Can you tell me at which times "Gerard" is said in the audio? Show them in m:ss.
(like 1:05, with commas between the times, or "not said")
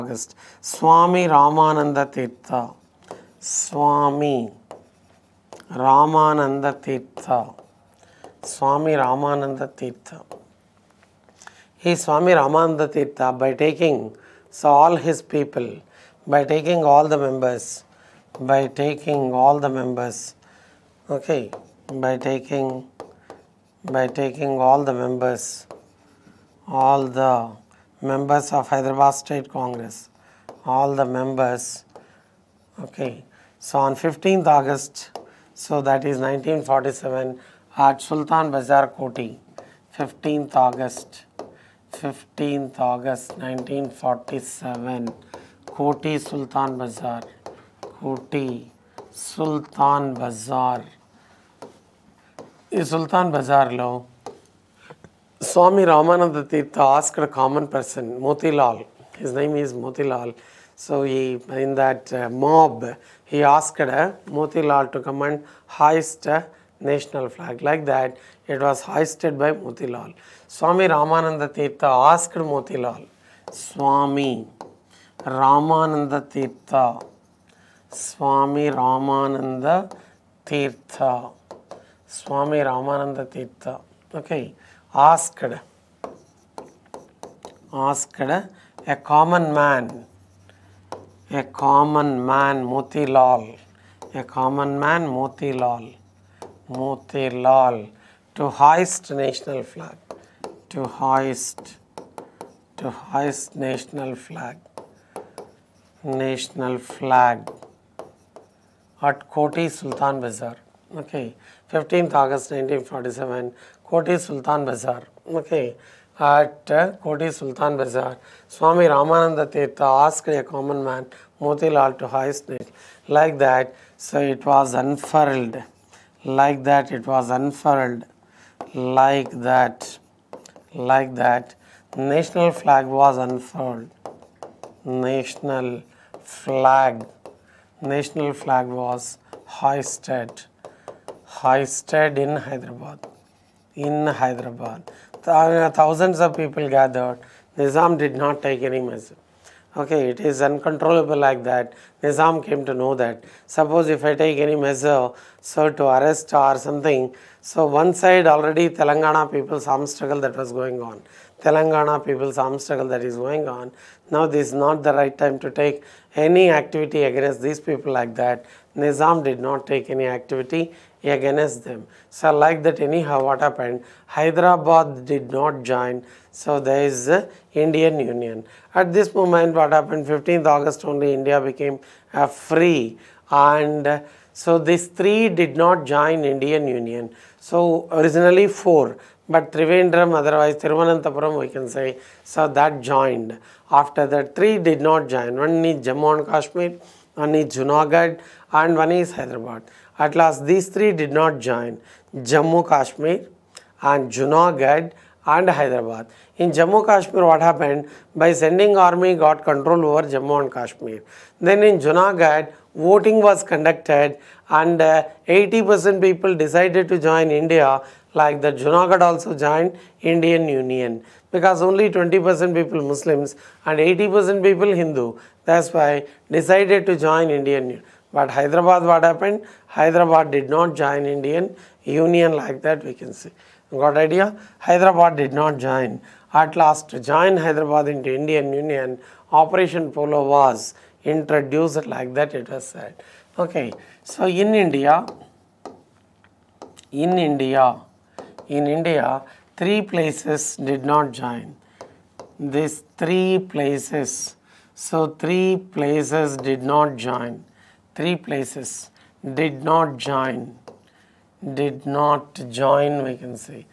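not said.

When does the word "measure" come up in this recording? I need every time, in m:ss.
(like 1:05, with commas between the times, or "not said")
2:28, 2:34.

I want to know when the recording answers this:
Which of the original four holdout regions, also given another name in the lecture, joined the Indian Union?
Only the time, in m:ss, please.
3:09.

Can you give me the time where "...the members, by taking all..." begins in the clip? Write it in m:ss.
0:17.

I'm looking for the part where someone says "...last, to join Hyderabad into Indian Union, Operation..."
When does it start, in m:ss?
3:56.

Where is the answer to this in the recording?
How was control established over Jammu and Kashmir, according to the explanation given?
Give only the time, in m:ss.
3:28.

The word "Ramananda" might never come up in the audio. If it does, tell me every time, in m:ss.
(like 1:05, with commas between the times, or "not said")
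1:58.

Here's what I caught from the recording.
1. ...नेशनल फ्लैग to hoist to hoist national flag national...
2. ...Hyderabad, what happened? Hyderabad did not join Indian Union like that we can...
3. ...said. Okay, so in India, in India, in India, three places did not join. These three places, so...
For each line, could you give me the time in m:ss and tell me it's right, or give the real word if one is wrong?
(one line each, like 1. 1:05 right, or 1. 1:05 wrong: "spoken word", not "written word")
1. 1:39 right
2. 3:48 right
3. 4:02 right.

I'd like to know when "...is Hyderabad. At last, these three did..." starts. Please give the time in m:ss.
3:18.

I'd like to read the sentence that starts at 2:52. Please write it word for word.
So like that anyhow what happened, Hyderabad did not join.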